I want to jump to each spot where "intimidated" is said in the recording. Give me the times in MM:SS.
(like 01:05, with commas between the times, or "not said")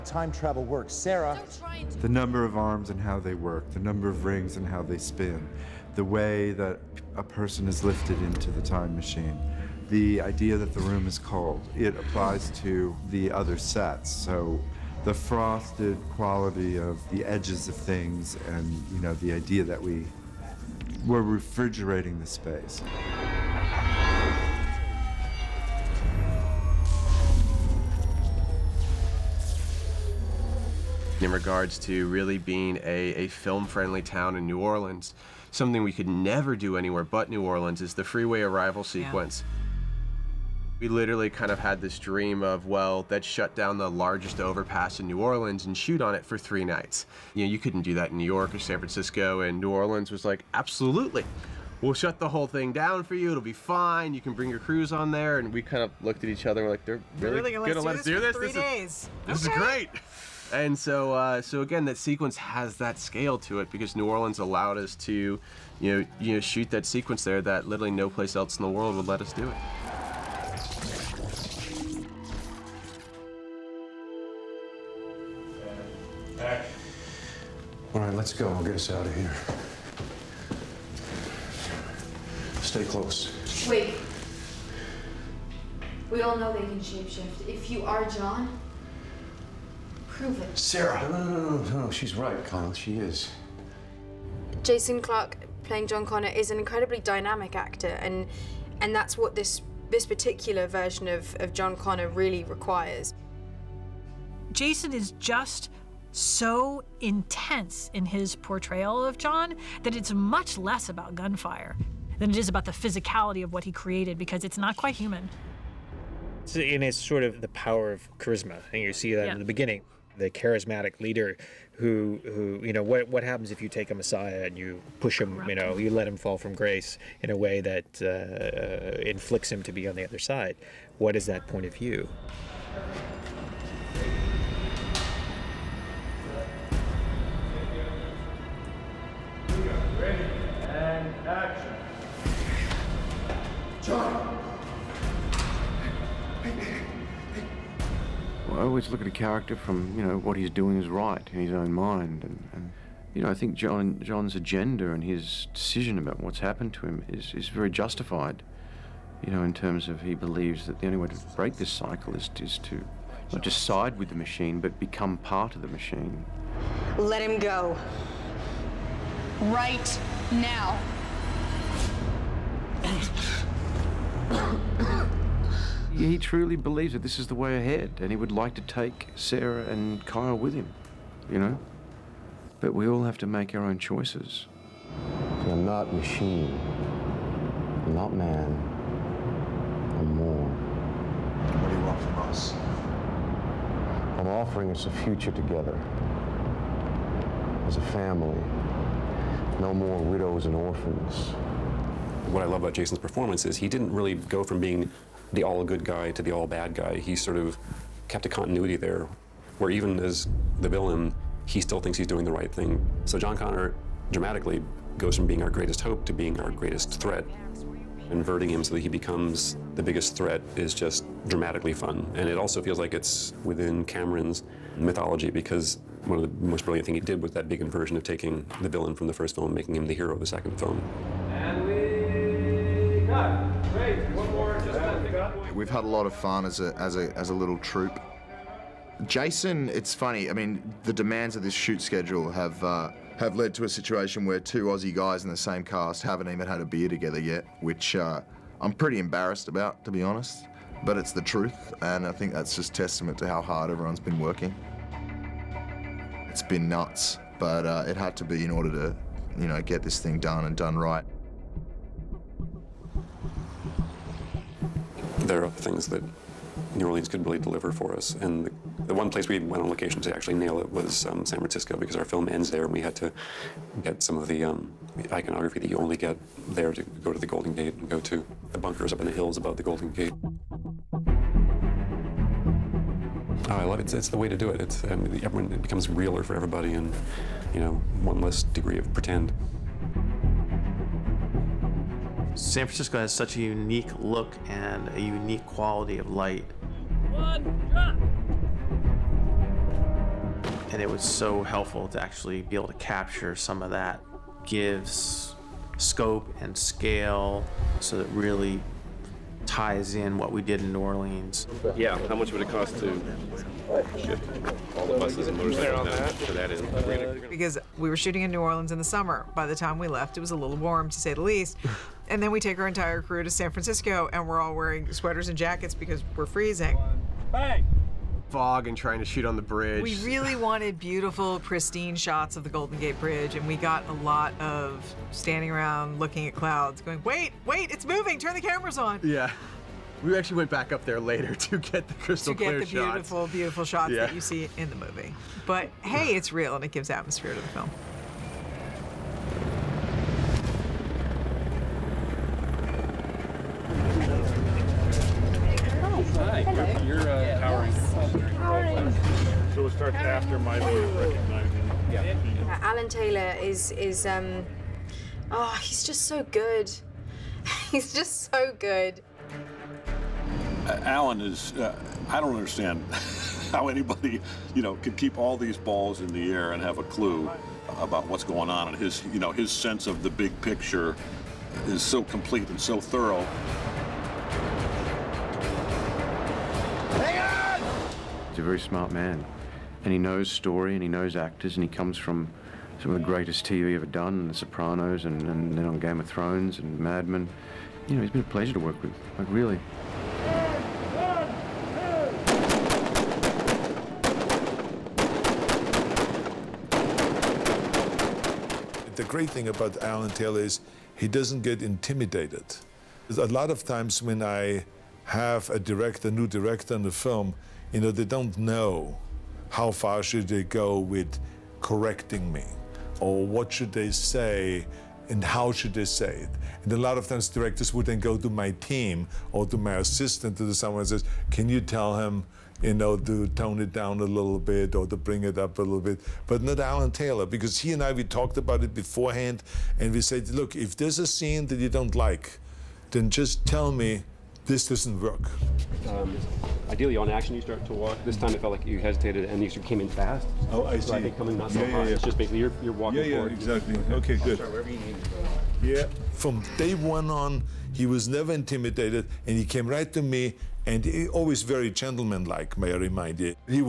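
06:51, 07:38.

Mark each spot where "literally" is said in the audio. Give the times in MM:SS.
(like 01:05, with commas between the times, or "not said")
00:40, 01:07.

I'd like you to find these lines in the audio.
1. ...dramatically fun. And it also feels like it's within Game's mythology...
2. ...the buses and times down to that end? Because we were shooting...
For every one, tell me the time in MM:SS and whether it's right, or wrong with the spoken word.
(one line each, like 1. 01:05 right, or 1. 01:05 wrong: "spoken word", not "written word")
1. 03:41 wrong: "Cameron", not "Game"
2. 05:14 wrong: "motorcycles", not "times".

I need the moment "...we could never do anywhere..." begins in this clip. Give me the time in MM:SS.
00:35.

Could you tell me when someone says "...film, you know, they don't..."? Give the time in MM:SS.
06:56.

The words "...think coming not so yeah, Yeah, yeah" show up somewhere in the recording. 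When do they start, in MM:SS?
07:31.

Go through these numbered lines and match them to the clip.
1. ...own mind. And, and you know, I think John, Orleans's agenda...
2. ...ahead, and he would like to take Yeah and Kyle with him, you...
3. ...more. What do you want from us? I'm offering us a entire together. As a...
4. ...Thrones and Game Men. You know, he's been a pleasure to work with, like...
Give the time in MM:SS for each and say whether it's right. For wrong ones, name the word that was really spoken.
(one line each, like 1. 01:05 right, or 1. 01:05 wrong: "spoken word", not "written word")
1. 02:31 wrong: "John", not "Orleans"
2. 02:57 wrong: "Sarah", not "Yeah"
3. 03:10 wrong: "future", not "entire"
4. 06:36 wrong: "Mad", not "Game".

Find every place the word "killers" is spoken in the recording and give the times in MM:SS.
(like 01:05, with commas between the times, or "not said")
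not said.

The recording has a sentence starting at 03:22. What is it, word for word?
What I love about Jason's performance is he didn't really go from being the all good guy to the all bad guy.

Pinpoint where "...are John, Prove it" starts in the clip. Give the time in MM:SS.
01:27.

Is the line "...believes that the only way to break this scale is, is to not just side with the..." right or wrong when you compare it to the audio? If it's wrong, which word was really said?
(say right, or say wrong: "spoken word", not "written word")
wrong: "cycle", not "scale".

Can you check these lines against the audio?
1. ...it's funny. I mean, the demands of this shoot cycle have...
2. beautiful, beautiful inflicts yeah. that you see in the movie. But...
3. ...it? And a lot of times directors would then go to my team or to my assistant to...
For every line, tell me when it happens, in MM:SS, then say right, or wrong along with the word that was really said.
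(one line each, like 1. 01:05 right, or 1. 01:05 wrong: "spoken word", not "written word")
1. 03:59 wrong: "schedule", not "cycle"
2. 05:42 wrong: "shots", not "inflicts"
3. 07:06 right.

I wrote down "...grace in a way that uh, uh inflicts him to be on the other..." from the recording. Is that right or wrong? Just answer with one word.
right.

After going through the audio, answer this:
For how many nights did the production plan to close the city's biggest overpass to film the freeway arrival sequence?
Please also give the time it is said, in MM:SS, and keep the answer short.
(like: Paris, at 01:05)
3, at 00:46.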